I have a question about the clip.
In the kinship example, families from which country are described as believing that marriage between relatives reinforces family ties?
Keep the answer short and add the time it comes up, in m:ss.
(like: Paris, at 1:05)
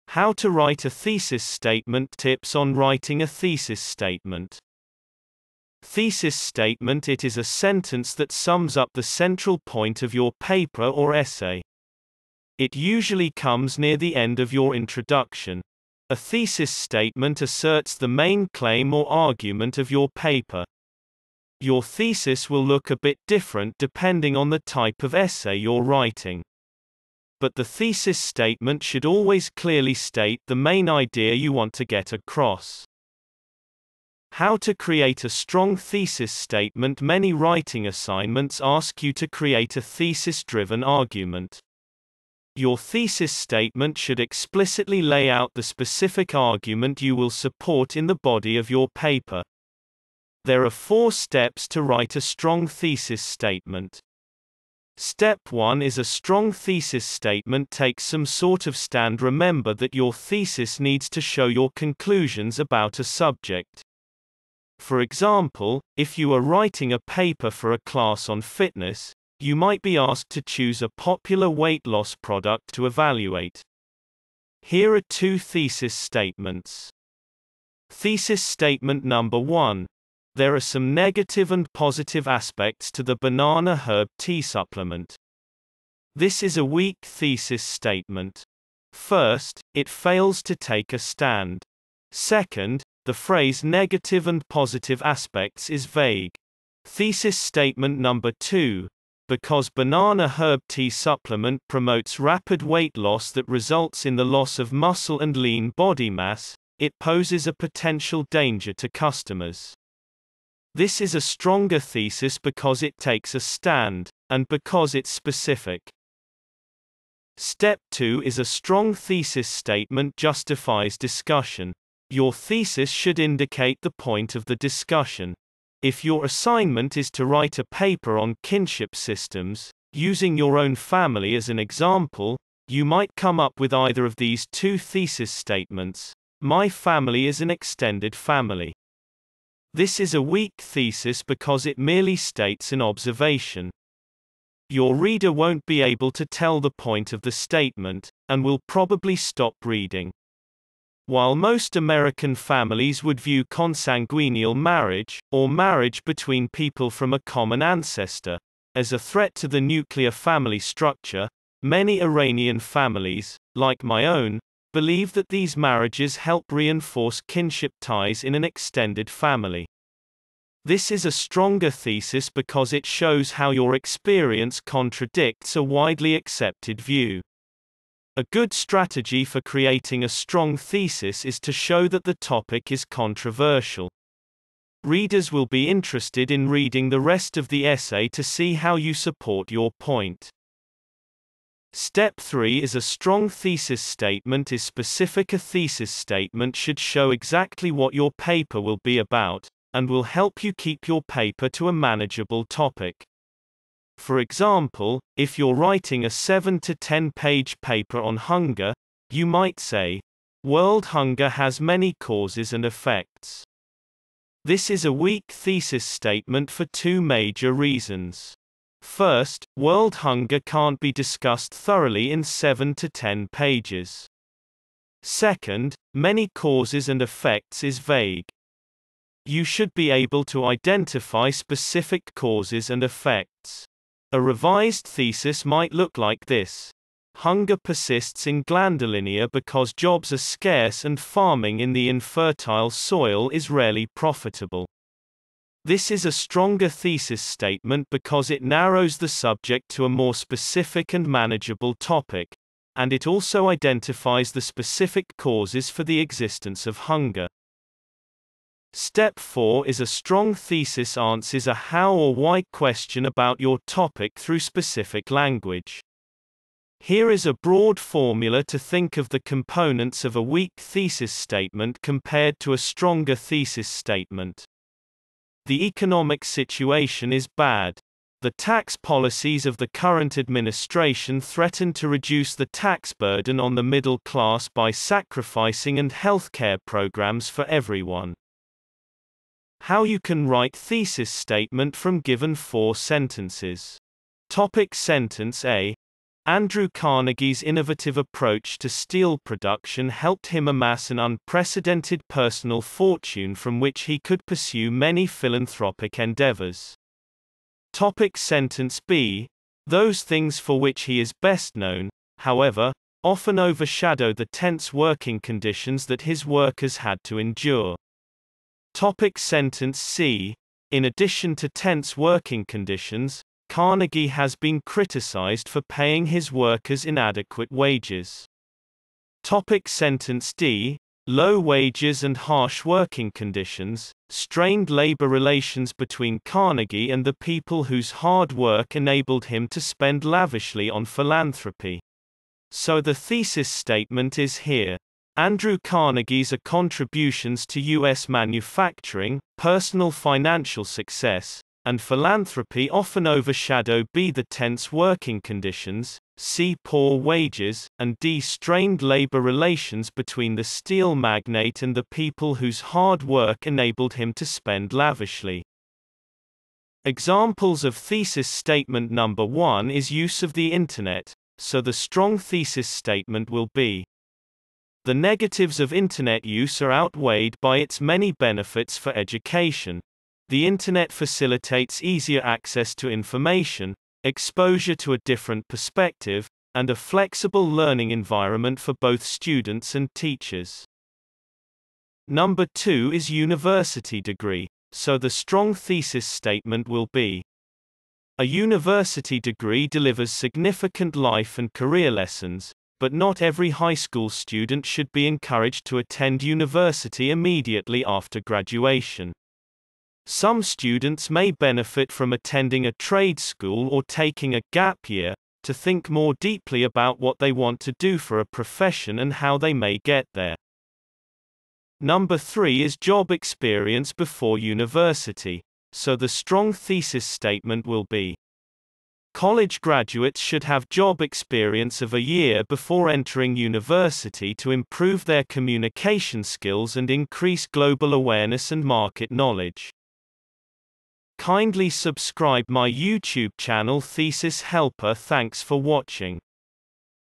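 Iranian, at 2:42.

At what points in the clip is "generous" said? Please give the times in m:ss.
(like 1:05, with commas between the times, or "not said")
not said.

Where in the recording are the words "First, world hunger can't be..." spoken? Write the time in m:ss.
3:38.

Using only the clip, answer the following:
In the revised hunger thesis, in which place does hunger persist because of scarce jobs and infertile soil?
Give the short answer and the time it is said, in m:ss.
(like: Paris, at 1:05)
Glandelinia, at 3:58.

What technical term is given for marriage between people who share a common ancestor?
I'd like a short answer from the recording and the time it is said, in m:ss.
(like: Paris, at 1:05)
Consanguineal marriage, at 2:33.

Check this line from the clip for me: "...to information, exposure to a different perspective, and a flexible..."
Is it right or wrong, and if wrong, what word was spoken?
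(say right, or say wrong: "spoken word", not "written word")
right.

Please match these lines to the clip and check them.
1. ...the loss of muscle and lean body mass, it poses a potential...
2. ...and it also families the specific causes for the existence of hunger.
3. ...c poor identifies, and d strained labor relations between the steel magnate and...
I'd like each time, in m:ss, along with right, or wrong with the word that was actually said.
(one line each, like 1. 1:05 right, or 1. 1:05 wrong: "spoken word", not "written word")
1. 1:44 right
2. 4:12 wrong: "identifies", not "families"
3. 5:56 wrong: "wages", not "identifies".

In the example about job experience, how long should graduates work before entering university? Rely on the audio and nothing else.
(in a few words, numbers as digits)
A year.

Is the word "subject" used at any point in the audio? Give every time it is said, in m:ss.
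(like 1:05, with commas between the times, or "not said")
1:03, 4:09.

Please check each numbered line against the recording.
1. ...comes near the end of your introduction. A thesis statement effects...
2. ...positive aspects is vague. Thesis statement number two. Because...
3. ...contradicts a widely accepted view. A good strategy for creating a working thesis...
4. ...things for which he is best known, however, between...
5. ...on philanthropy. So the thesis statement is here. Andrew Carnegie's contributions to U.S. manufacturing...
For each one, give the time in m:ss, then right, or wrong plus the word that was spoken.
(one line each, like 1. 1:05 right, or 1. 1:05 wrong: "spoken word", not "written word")
1. 0:13 wrong: "asserts", not "effects"
2. 1:34 right
3. 2:54 wrong: "strong", not "working"
4. 5:10 wrong: "often", not "between"
5. 5:40 right.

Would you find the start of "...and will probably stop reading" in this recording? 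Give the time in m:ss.
2:28.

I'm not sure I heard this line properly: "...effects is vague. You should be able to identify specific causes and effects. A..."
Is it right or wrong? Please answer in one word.
right.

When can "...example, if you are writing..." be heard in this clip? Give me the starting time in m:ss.
1:04.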